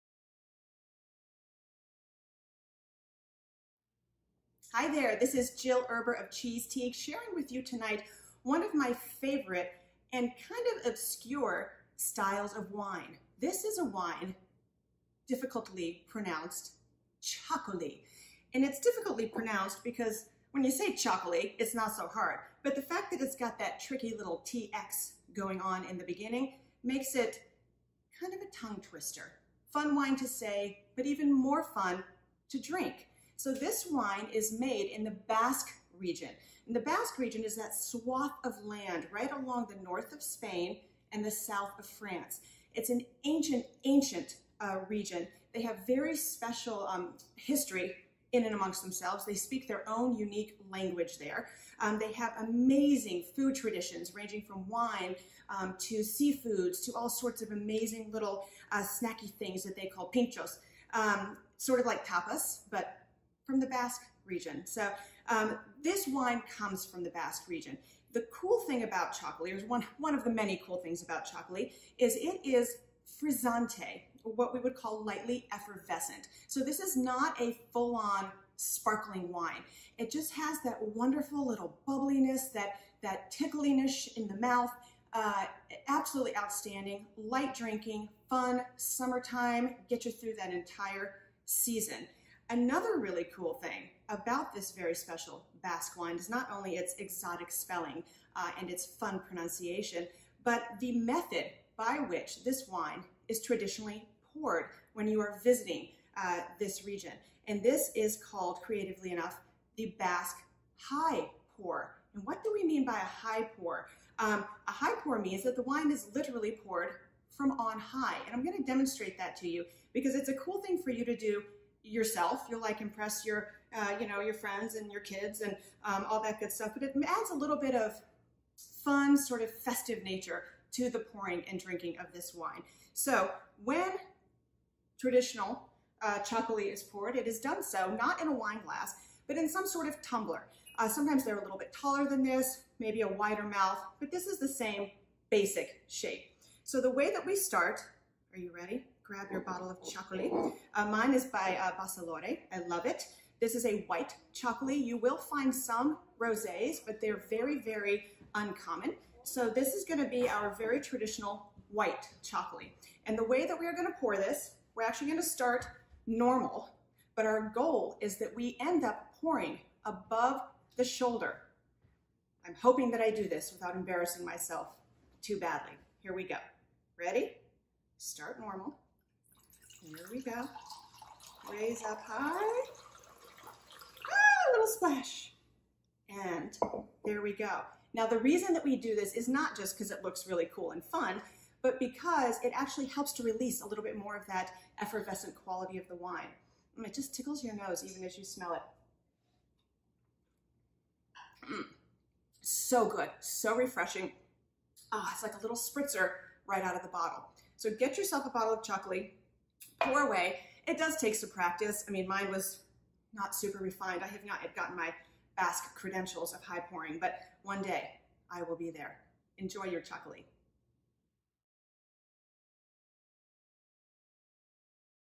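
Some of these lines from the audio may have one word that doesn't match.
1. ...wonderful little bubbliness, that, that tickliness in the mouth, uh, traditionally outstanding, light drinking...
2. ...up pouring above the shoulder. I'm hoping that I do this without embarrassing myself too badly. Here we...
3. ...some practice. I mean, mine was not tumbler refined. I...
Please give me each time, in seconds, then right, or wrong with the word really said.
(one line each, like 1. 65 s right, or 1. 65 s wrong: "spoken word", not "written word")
1. 80 s wrong: "absolutely", not "traditionally"
2. 168 s right
3. 211 s wrong: "super", not "tumbler".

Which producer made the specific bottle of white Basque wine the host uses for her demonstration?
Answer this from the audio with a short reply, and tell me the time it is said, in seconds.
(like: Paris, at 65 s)
Basalore, at 151 s.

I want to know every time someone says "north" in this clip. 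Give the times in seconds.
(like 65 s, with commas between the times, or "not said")
39 s.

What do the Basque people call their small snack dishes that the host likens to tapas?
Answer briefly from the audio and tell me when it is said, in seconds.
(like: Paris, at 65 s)
pinchos, at 60 s.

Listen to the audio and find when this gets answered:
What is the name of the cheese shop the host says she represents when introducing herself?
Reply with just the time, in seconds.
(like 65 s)
6 s.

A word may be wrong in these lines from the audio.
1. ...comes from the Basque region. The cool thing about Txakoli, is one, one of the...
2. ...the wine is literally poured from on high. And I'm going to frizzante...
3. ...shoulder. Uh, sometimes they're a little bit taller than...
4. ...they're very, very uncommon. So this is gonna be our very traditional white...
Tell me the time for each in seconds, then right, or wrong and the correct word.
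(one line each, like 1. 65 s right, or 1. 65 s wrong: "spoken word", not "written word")
1. 66 s right
2. 115 s wrong: "demonstrate", not "frizzante"
3. 140 s wrong: "tumbler", not "shoulder"
4. 157 s right.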